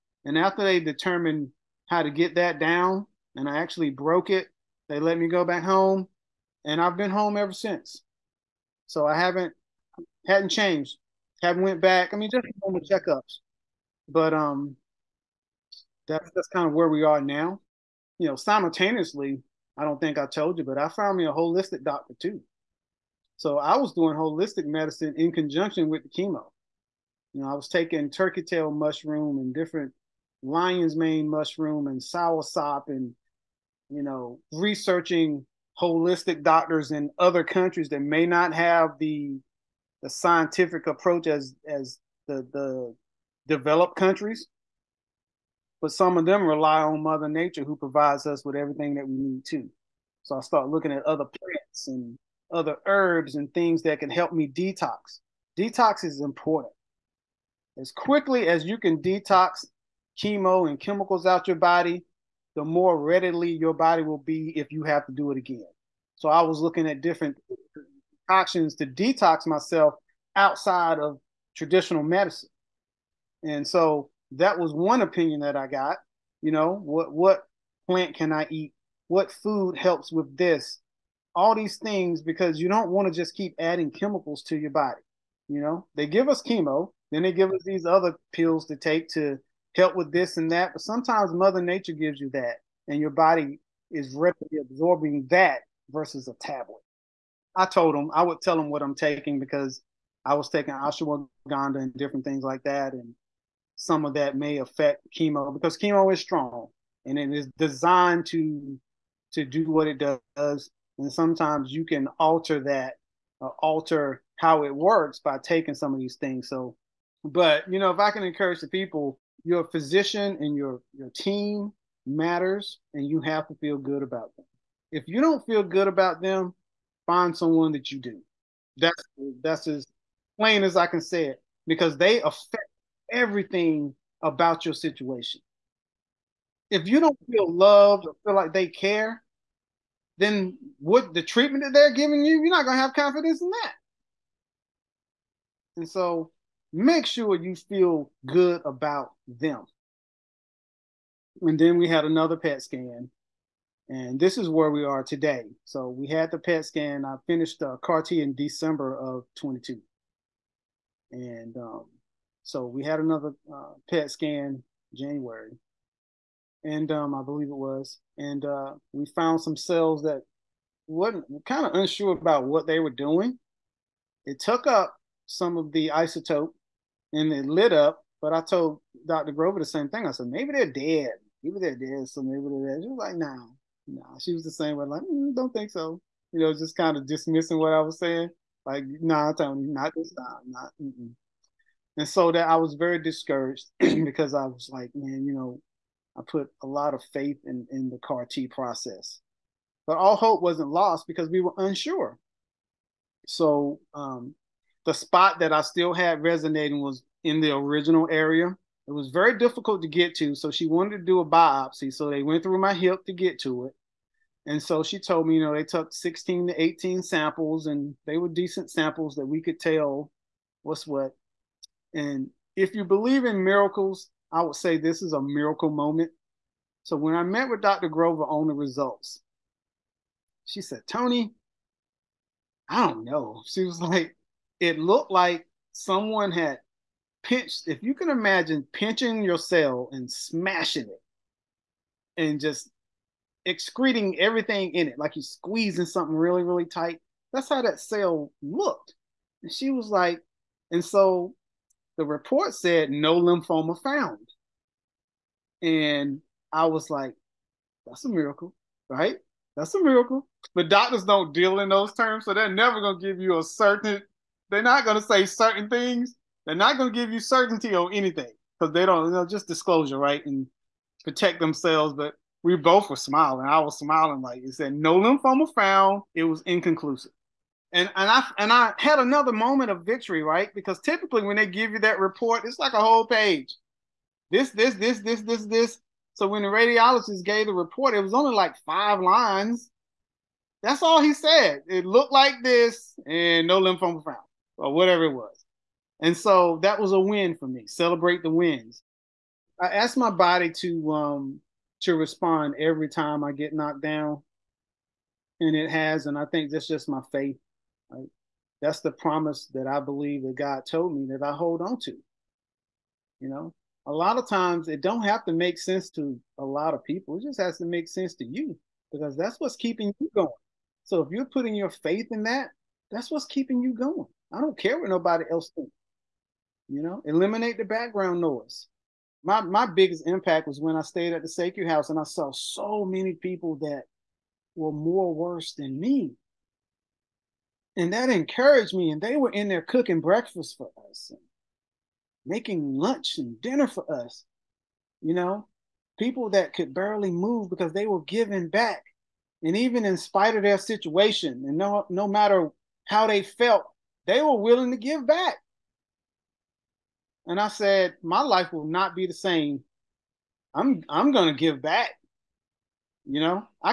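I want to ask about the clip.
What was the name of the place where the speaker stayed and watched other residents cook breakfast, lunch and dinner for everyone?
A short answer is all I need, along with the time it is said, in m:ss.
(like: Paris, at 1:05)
SECU House, at 5:31.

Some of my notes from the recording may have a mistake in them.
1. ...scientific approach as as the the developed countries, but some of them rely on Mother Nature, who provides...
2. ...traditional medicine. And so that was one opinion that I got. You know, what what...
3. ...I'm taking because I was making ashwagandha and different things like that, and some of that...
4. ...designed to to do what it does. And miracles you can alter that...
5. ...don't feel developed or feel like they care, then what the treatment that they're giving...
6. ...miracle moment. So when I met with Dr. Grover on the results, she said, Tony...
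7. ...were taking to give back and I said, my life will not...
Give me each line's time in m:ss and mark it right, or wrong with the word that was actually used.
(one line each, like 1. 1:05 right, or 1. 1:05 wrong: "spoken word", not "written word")
1. 0:40 right
2. 1:11 right
3. 1:38 wrong: "taking", not "making"
4. 1:47 wrong: "sometimes", not "miracles"
5. 2:16 wrong: "loved", not "developed"
6. 3:45 right
7. 5:54 wrong: "willing", not "taking".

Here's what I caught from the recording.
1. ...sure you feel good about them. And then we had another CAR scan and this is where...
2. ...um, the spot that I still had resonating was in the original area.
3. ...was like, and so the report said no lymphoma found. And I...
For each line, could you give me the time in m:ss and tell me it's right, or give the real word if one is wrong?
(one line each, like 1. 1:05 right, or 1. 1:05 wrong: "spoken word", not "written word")
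1. 2:27 wrong: "PET", not "CAR"
2. 3:23 right
3. 4:09 right.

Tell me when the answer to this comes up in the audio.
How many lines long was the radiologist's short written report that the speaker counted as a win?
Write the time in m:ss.
4:48.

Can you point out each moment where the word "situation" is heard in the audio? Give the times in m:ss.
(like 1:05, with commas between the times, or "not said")
2:14, 5:50.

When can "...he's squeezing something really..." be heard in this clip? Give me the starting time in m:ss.
4:05.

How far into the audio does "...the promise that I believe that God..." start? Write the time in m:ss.
5:08.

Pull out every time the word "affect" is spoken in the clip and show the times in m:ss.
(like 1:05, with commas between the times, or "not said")
1:44, 2:12.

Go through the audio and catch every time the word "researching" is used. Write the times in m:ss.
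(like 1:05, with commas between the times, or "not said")
0:34.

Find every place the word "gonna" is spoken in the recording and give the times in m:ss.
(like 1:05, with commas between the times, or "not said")
2:22, 6:01.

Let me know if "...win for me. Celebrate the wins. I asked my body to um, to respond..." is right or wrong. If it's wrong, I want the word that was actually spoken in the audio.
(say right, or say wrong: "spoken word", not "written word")
right.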